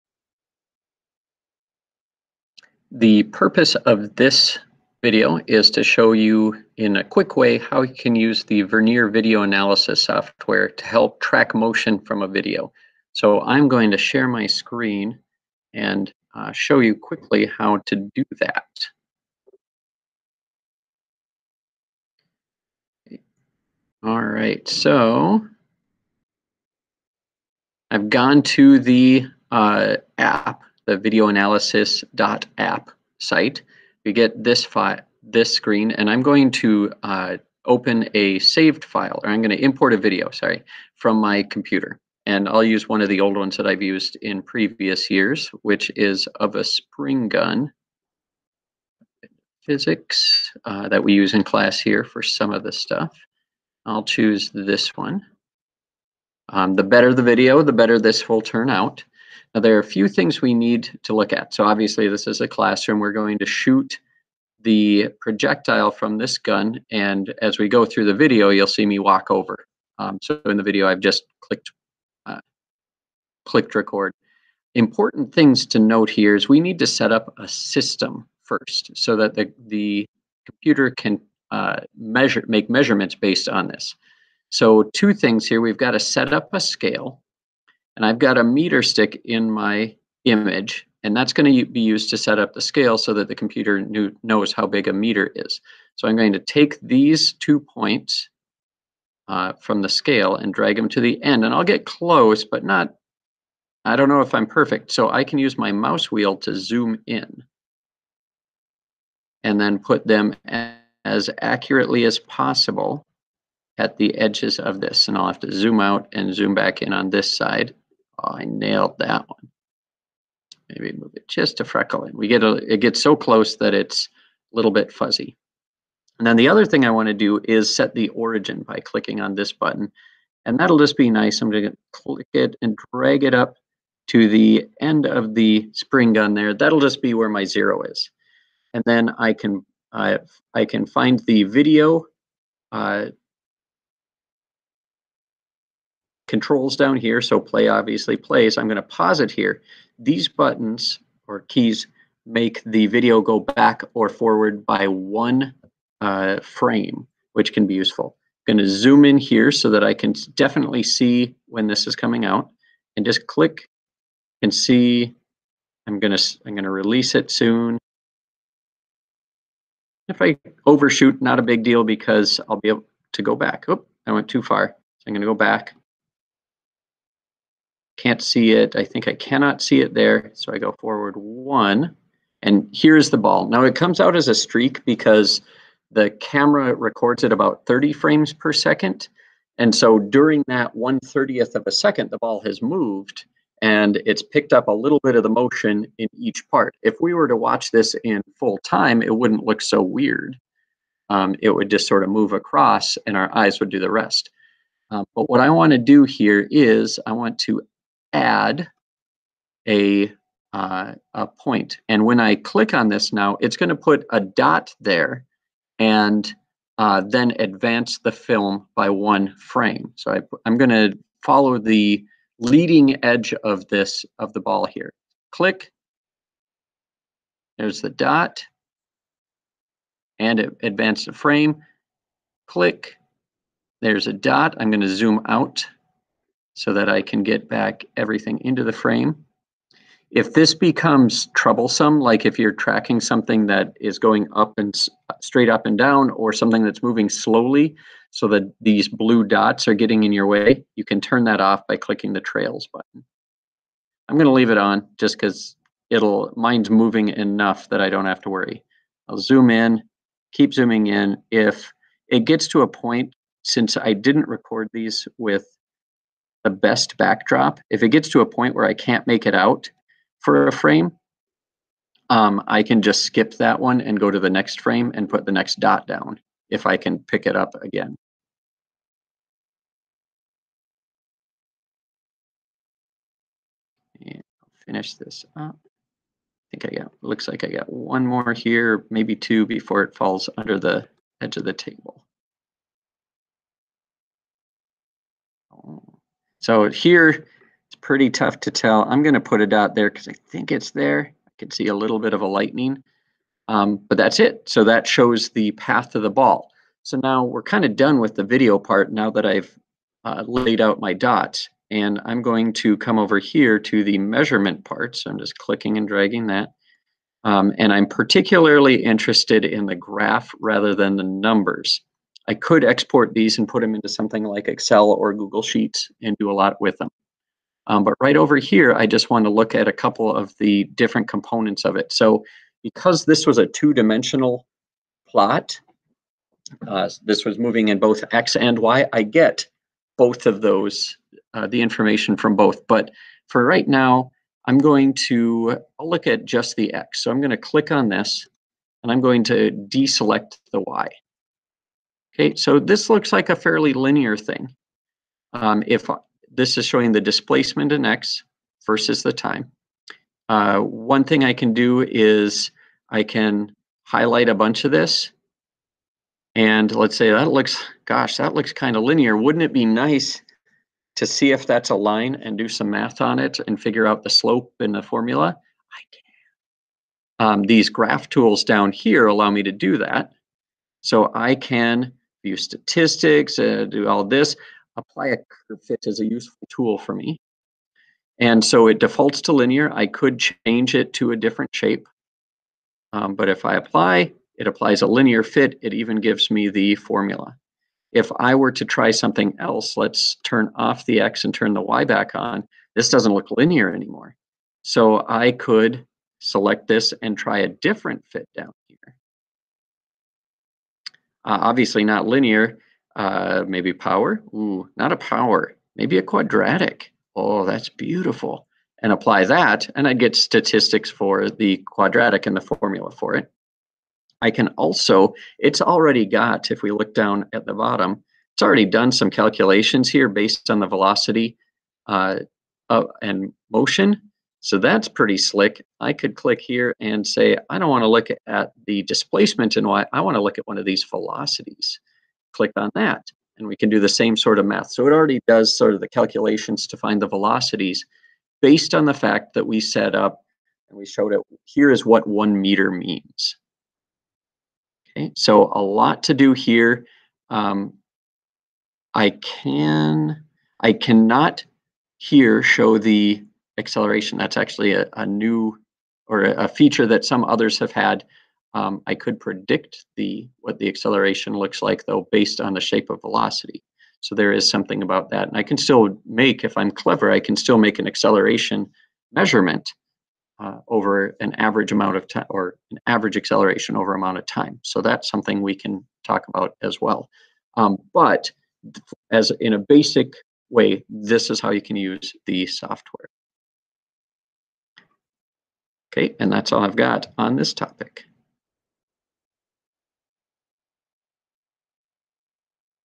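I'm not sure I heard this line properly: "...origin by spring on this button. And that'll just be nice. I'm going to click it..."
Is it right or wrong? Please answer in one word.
wrong.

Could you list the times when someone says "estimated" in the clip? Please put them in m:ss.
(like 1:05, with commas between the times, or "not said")
not said.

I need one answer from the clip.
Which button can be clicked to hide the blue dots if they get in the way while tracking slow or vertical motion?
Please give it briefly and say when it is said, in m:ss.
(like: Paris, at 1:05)
Trails, at 4:12.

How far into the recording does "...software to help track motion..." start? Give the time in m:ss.
0:10.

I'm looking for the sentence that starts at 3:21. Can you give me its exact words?
Um, it would just sort of move across and our eyes would do the rest.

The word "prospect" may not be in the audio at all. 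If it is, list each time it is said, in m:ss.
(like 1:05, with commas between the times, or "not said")
not said.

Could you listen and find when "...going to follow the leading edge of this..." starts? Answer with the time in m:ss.
3:40.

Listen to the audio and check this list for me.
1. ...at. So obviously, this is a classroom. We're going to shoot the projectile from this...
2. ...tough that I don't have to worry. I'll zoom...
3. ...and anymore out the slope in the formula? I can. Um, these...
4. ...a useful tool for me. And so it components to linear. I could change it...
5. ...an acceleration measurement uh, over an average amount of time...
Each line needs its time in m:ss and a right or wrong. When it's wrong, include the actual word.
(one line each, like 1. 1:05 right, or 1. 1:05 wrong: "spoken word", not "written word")
1. 1:01 right
2. 4:17 wrong: "enough", not "tough"
3. 6:13 wrong: "figure", not "anymore"
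4. 6:25 wrong: "defaults", not "components"
5. 7:57 right.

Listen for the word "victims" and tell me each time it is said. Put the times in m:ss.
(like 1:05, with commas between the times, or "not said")
not said.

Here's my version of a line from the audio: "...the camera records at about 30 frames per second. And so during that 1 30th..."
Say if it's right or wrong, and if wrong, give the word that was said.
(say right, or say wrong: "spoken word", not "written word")
right.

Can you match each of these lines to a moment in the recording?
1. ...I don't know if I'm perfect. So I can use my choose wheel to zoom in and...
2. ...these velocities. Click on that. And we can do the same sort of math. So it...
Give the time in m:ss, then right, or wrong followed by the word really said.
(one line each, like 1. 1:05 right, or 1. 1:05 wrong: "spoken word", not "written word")
1. 1:43 wrong: "mouse", not "choose"
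2. 7:20 right.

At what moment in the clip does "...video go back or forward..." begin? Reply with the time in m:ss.
2:32.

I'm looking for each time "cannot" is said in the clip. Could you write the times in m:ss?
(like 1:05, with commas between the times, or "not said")
2:59, 7:40.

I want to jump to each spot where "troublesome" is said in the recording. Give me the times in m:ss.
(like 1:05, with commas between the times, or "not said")
4:01.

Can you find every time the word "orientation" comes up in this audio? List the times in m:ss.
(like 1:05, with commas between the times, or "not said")
not said.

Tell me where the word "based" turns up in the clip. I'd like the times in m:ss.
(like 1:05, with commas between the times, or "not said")
1:23, 7:10, 7:28, 7:52.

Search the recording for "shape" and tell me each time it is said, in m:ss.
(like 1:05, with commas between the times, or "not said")
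6:31, 7:52.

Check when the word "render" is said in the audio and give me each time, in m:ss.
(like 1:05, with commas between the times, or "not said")
not said.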